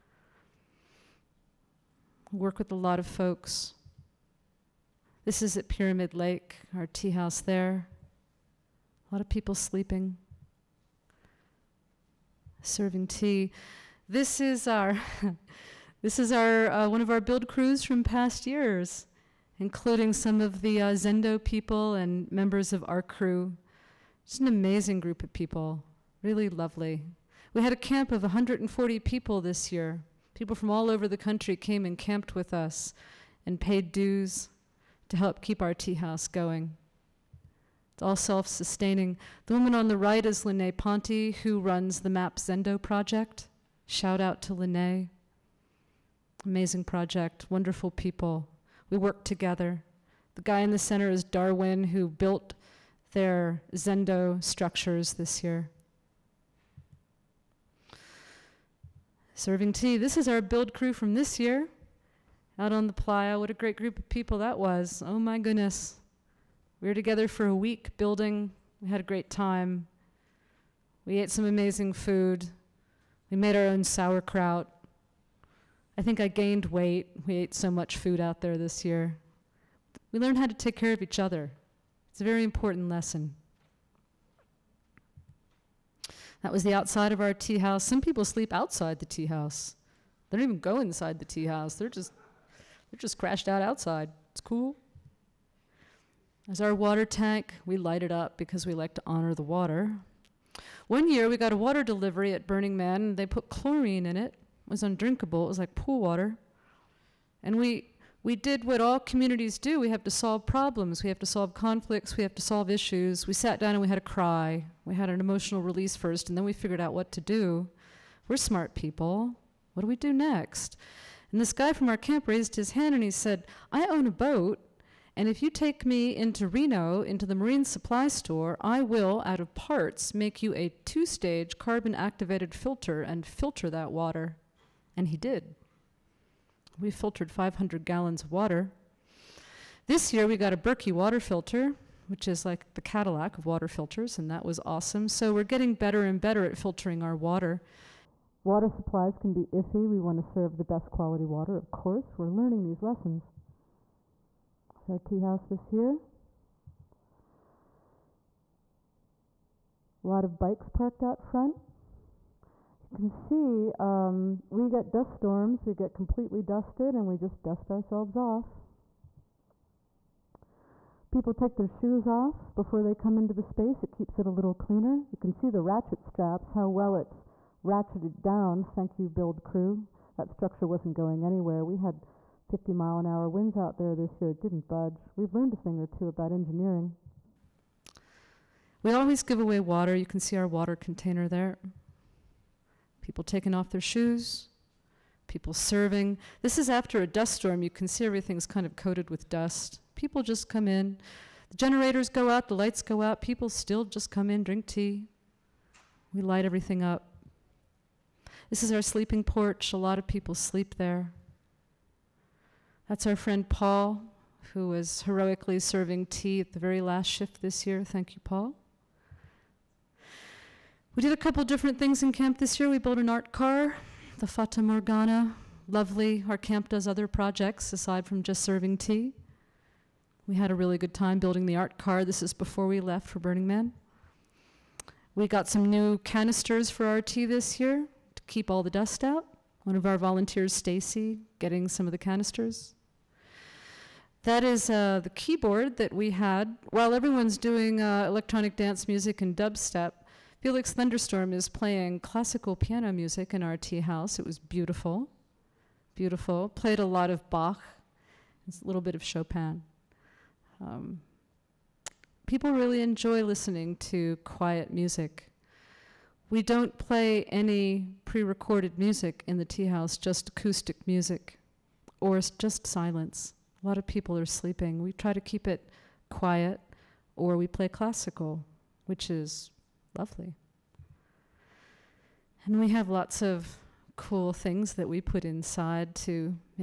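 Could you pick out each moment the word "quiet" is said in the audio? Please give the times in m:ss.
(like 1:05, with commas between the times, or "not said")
4:24, 4:36.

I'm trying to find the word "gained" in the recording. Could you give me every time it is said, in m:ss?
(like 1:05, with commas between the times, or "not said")
1:16.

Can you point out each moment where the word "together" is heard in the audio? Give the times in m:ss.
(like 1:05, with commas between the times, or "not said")
0:49, 1:06.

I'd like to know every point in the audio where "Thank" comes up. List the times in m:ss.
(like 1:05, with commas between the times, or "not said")
2:58, 3:37.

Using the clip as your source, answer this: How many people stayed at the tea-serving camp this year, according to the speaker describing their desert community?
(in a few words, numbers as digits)
140.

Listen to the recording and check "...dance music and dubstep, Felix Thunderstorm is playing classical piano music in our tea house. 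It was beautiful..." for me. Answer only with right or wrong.
right.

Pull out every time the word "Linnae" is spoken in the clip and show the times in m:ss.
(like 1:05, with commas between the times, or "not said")
0:40, 0:44.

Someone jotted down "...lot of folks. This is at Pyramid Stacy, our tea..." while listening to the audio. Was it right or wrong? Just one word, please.
wrong.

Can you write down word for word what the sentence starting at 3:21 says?
The generators go out, the lights go out.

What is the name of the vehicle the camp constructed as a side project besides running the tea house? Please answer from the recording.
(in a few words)
Fata Morgana.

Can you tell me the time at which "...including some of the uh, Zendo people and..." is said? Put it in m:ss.
0:19.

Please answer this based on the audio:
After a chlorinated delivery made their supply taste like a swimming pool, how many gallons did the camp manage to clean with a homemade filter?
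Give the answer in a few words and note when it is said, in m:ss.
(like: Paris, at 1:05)
500, at 2:17.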